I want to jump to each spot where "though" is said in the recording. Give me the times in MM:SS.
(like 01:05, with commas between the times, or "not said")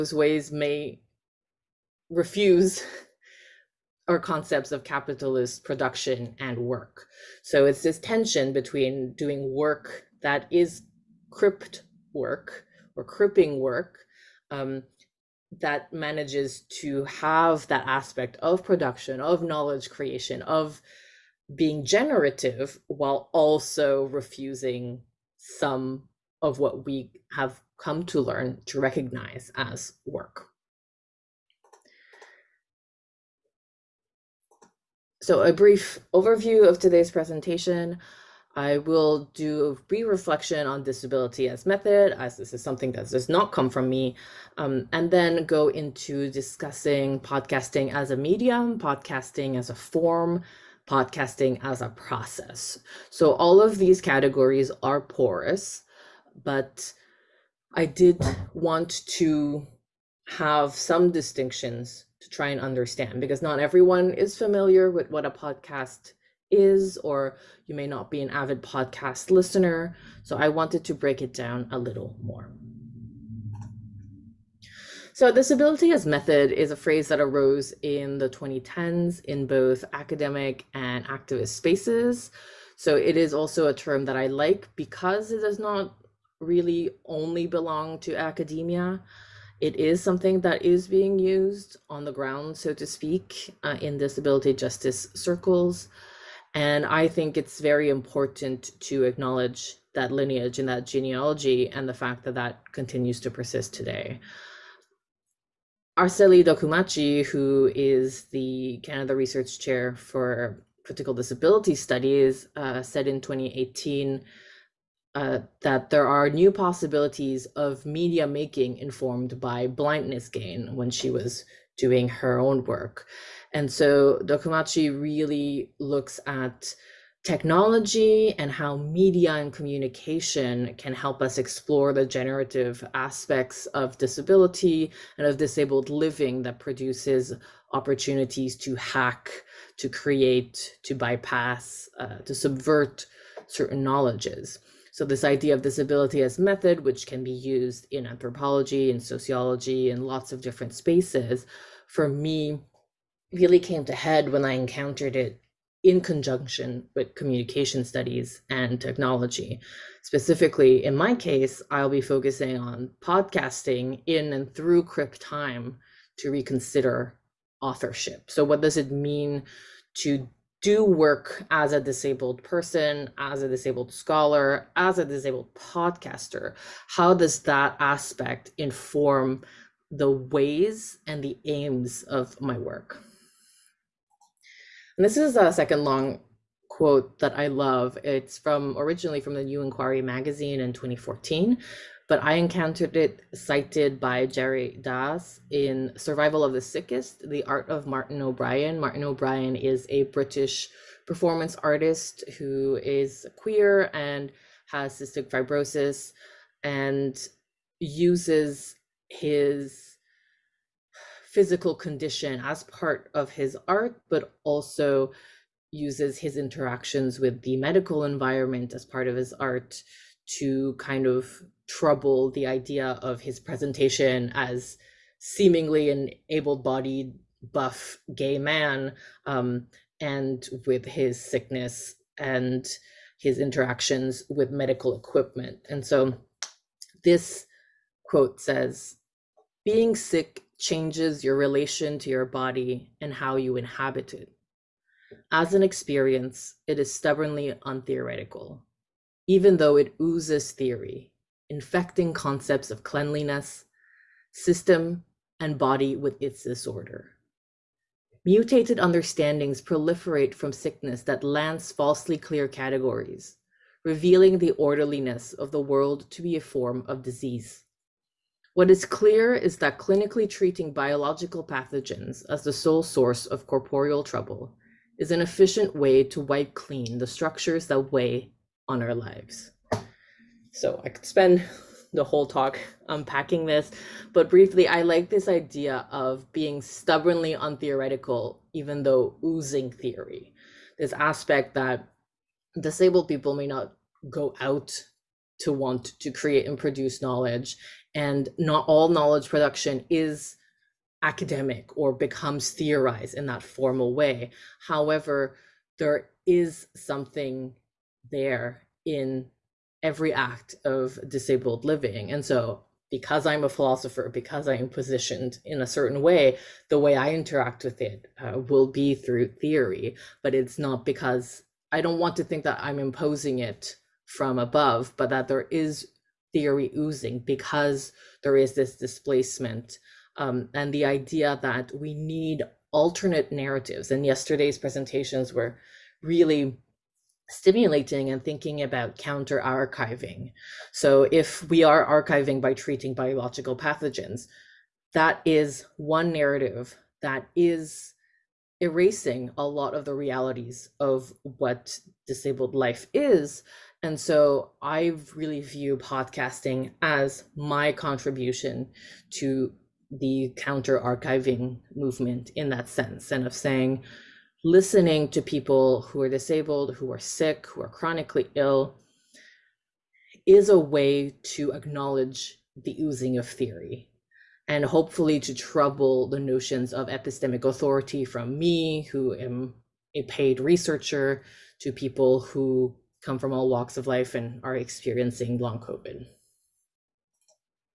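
04:09, 04:48.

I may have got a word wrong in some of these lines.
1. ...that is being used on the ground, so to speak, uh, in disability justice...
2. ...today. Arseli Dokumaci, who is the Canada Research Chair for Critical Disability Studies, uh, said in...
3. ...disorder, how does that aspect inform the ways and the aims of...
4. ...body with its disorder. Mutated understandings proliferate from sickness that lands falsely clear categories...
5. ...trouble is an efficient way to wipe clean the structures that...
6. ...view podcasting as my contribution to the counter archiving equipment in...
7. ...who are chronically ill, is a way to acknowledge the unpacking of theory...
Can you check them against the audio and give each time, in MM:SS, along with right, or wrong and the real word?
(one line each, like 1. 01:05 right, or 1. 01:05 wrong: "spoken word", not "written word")
1. 01:30 right
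2. 01:43 right
3. 02:55 wrong: "podcaster", not "disorder"
4. 04:15 right
5. 04:34 right
6. 05:55 wrong: "movement", not "equipment"
7. 06:07 wrong: "oozing", not "unpacking".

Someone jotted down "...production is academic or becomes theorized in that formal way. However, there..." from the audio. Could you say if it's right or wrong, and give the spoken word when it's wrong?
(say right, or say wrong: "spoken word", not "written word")
right.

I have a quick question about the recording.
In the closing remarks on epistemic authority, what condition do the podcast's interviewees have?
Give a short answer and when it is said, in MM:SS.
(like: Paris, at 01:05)
Long COVID, at 06:25.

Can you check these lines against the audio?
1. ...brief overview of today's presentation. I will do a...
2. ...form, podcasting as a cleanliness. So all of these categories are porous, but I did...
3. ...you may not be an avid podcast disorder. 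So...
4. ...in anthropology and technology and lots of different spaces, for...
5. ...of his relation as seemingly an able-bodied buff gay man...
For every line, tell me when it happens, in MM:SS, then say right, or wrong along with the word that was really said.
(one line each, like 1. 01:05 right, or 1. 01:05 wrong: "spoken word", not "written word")
1. 00:35 right
2. 00:49 wrong: "process", not "cleanliness"
3. 01:07 wrong: "listener", not "disorder"
4. 02:27 wrong: "sociology", not "technology"
5. 03:43 wrong: "presentation", not "relation".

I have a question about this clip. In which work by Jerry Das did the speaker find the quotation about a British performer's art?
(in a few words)
Survival of the Sickest.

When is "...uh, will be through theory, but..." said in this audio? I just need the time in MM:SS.
05:18.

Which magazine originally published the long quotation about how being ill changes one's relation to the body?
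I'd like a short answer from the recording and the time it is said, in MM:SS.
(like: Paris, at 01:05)
The New Inquiry, at 03:09.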